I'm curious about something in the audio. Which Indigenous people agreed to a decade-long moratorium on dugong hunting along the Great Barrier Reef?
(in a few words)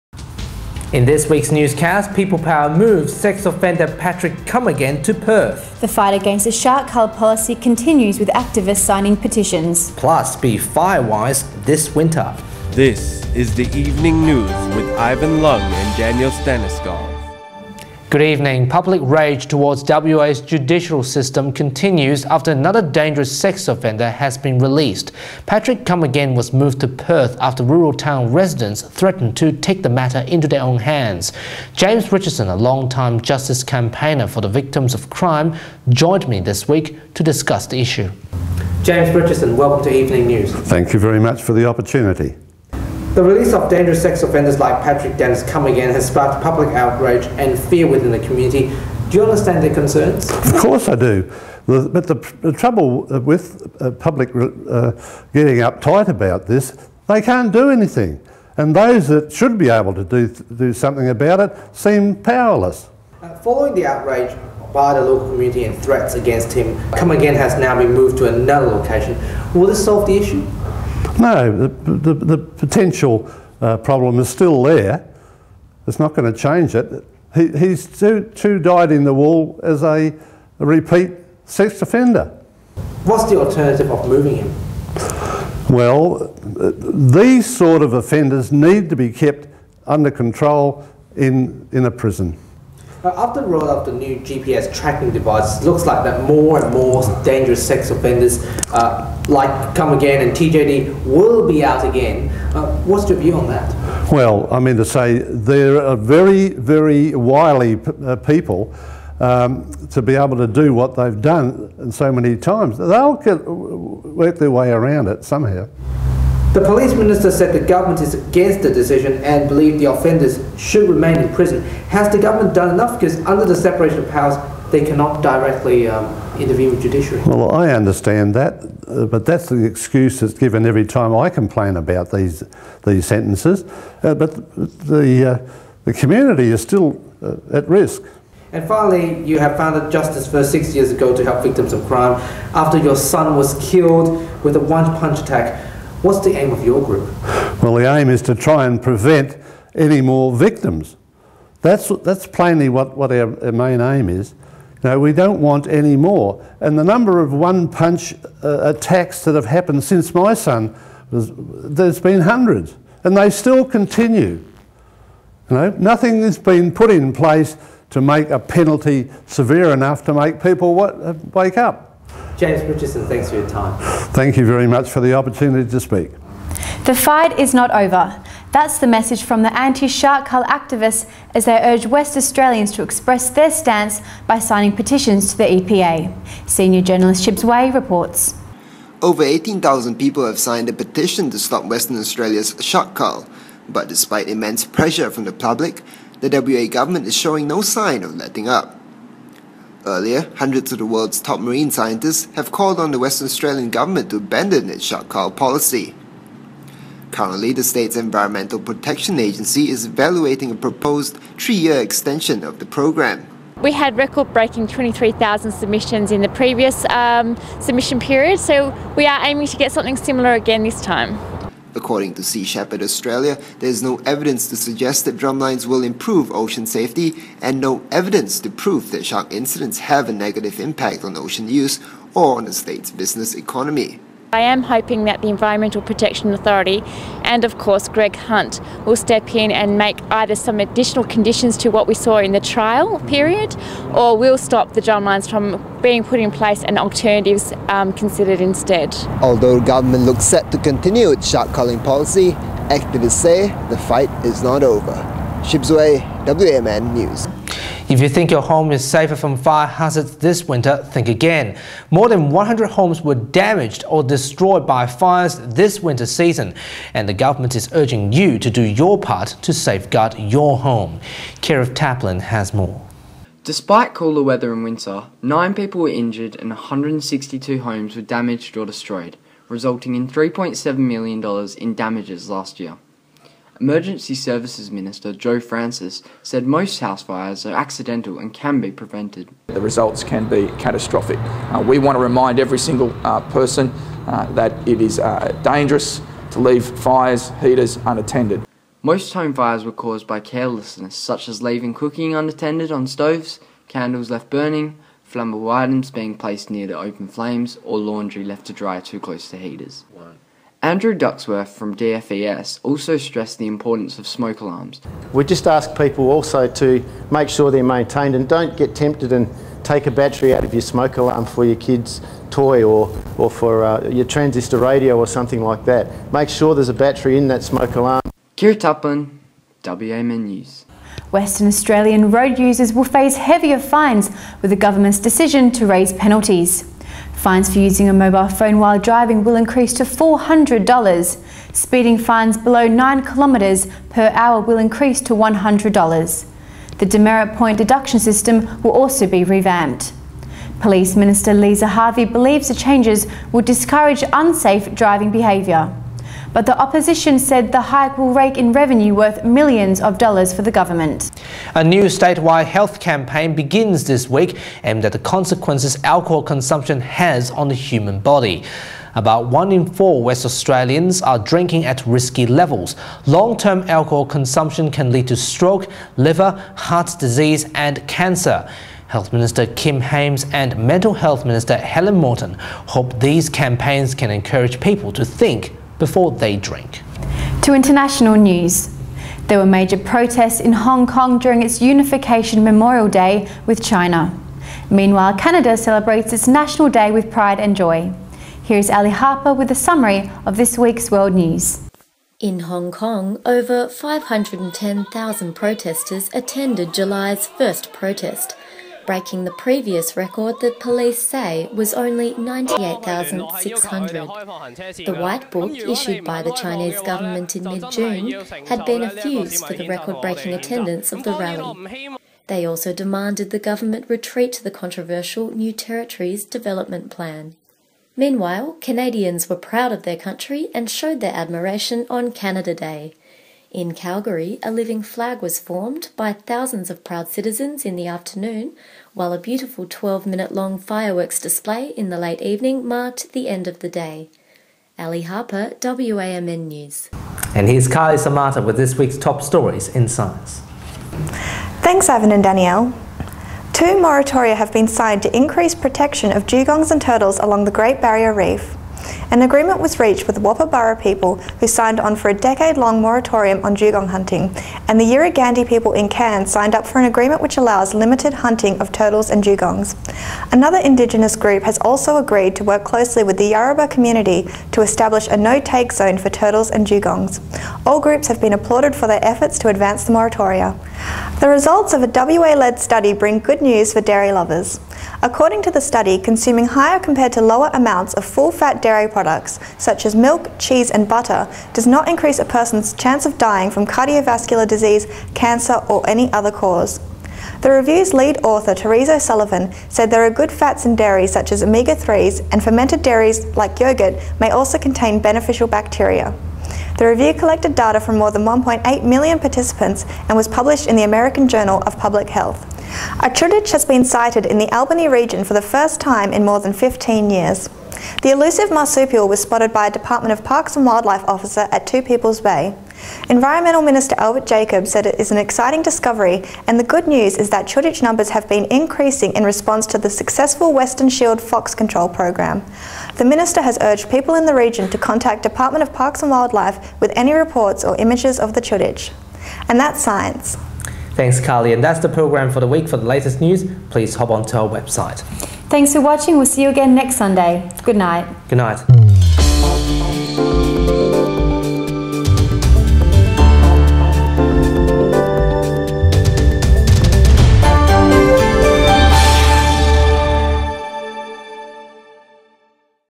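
Woppaburra.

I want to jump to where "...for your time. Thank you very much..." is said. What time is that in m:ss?
2:53.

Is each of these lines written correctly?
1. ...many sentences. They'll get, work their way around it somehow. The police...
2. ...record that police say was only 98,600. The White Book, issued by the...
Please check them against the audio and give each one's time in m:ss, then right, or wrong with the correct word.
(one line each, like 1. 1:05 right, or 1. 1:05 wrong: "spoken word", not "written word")
1. 1:52 wrong: "times", not "sentences"
2. 6:49 right.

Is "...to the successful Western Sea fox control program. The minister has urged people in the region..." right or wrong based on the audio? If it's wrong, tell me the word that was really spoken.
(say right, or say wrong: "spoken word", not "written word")
wrong: "Shield", not "Sea".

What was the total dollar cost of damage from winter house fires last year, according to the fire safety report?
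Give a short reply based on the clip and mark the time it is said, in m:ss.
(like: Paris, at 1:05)
$3.7 million, at 4:40.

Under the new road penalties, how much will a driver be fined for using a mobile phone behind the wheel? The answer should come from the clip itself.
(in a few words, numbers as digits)
$400.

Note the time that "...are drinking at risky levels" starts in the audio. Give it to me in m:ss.
6:11.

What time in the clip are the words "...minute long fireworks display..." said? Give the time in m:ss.
7:20.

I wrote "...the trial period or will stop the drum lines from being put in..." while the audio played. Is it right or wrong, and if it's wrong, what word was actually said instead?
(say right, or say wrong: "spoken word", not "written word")
right.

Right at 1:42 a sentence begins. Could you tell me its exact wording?
Uh, what's your view on that?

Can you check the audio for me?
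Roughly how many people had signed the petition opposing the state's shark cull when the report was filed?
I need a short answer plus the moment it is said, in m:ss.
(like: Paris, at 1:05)
18,000, at 3:09.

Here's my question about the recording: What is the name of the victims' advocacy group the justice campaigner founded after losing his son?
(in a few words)
Justice First.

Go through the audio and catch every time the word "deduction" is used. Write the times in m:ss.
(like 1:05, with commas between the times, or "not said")
5:47.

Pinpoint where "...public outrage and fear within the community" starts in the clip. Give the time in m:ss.
0:46.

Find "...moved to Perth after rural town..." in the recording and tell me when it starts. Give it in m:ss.
0:26.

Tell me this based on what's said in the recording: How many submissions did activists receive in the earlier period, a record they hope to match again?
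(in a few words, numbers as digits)
23,000.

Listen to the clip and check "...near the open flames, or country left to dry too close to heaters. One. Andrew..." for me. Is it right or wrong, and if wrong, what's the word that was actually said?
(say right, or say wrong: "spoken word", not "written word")
wrong: "laundry", not "country".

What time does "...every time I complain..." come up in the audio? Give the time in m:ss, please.
2:10.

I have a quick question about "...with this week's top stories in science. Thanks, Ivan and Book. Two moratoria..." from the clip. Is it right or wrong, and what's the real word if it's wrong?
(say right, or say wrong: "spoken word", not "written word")
wrong: "Danielle", not "Book".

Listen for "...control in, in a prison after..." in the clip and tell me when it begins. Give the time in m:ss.
1:30.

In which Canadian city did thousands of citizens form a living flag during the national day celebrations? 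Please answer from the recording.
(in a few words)
Calgary.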